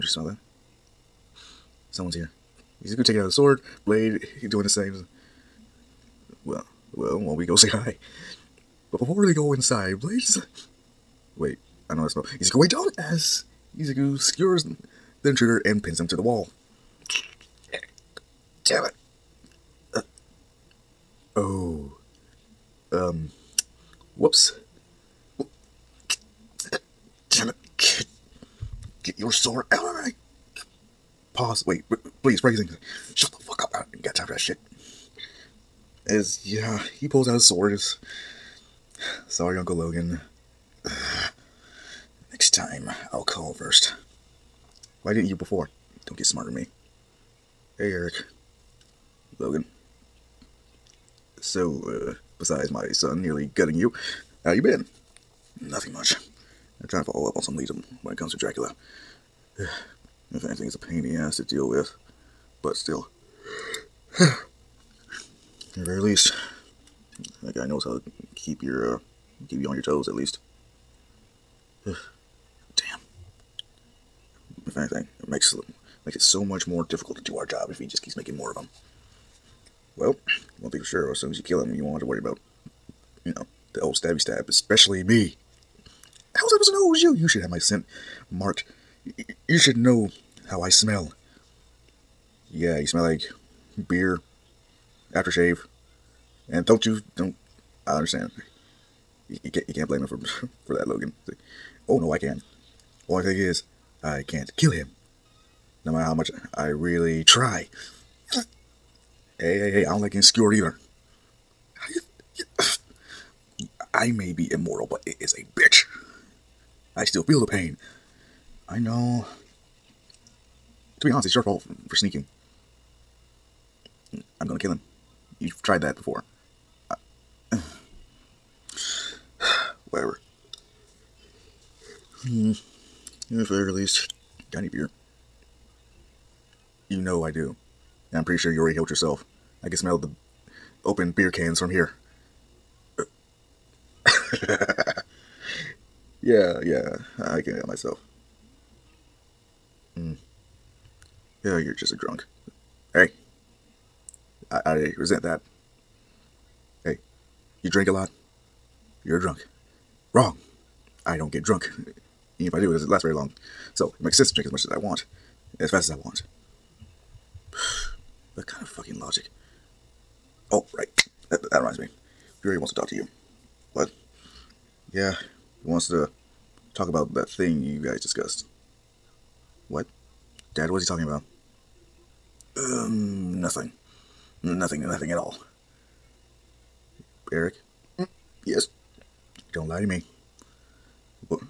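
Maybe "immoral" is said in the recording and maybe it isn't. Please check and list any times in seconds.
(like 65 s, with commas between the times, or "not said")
114 s.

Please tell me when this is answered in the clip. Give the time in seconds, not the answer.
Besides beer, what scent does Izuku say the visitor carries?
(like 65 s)
95 s.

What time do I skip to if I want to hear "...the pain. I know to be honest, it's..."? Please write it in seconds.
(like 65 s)
117 s.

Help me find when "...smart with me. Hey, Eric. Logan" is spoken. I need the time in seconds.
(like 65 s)
46 s.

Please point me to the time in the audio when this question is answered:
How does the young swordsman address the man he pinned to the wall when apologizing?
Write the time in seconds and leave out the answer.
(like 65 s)
39 s.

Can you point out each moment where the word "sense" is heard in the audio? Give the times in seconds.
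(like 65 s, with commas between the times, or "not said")
164 s.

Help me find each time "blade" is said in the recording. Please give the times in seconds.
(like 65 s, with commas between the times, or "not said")
3 s, 9 s.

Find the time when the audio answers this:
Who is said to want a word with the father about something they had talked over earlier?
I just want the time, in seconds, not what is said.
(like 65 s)
172 s.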